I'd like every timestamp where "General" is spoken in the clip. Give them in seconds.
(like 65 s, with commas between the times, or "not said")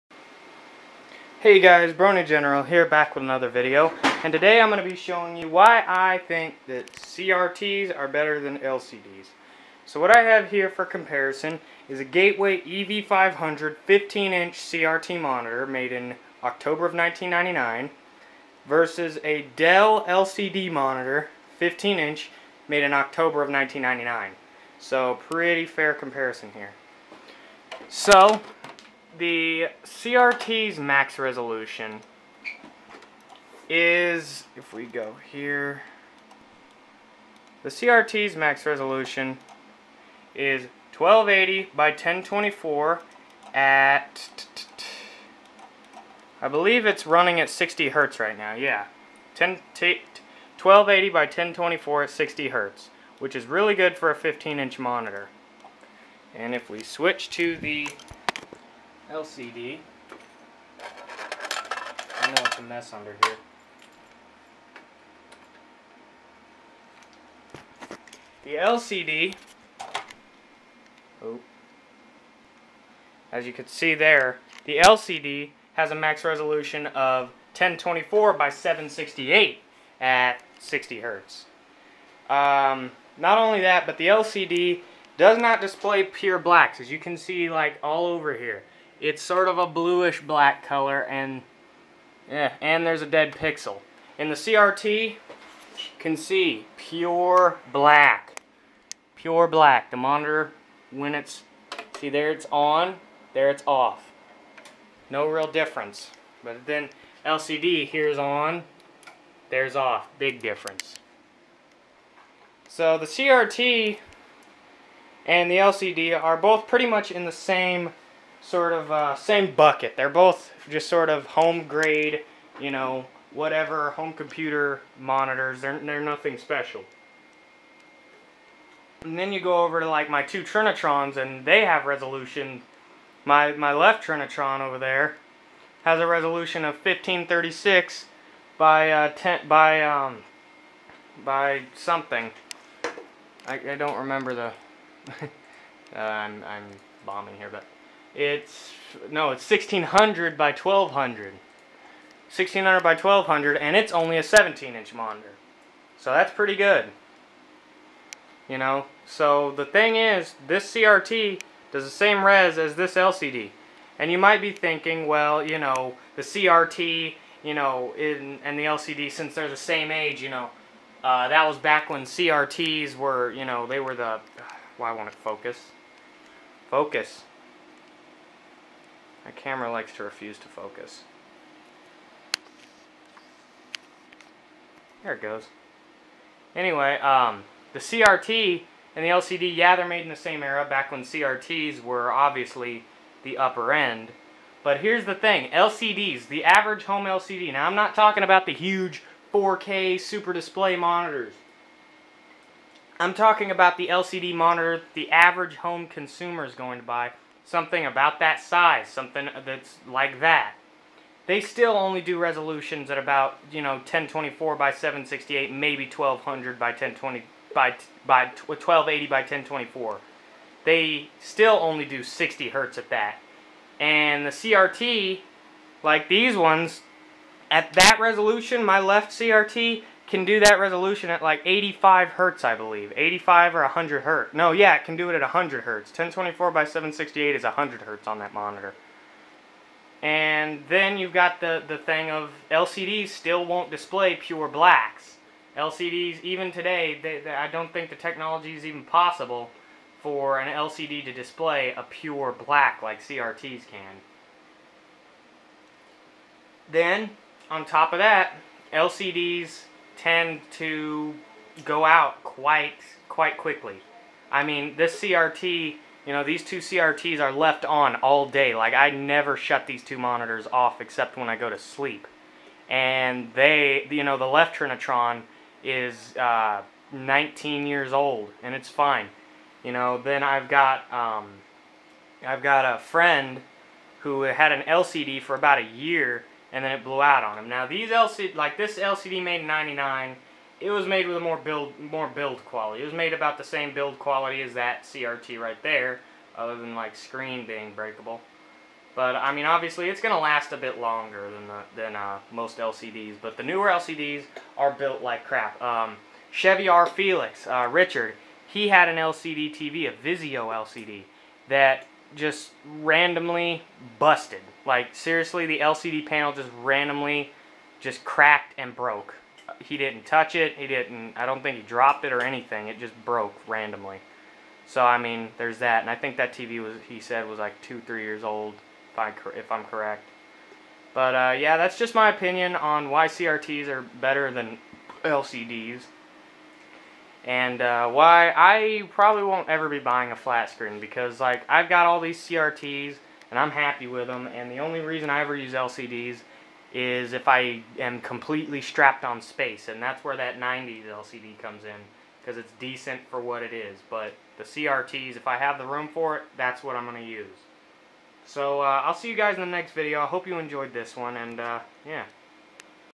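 2 s.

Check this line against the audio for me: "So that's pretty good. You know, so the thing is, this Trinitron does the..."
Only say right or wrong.
wrong.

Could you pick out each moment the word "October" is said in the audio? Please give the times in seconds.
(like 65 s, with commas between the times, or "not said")
16 s, 22 s.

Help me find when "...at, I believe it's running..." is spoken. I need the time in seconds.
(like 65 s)
43 s.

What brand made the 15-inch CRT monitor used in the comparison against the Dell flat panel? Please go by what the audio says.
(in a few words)
Gateway.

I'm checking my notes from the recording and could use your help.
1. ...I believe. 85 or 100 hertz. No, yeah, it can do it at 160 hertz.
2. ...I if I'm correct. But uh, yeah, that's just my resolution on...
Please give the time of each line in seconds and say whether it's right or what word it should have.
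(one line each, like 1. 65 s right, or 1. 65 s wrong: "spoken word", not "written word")
1. 232 s wrong: "100", not "160"
2. 328 s wrong: "opinion", not "resolution".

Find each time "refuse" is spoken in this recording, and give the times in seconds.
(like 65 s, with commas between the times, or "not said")
180 s.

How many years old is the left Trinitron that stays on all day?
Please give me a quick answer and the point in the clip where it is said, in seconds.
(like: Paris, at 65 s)
19, at 276 s.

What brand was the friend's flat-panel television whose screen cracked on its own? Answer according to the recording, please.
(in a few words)
Vizio.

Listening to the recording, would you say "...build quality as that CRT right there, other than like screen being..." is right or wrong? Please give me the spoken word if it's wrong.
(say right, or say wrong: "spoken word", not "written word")
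right.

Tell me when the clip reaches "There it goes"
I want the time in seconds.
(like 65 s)
185 s.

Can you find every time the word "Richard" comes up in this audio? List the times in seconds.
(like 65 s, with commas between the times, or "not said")
307 s.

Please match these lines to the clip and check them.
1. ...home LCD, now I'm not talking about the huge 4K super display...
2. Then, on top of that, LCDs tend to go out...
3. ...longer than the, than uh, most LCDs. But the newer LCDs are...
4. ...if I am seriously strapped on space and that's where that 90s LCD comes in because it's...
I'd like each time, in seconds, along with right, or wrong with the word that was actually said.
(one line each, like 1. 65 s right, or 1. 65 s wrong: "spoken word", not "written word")
1. 196 s right
2. 256 s right
3. 300 s right
4. 347 s wrong: "completely", not "seriously".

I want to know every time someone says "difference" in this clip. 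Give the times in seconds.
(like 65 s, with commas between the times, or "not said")
105 s, 110 s.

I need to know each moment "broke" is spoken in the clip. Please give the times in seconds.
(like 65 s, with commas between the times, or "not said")
318 s, 323 s.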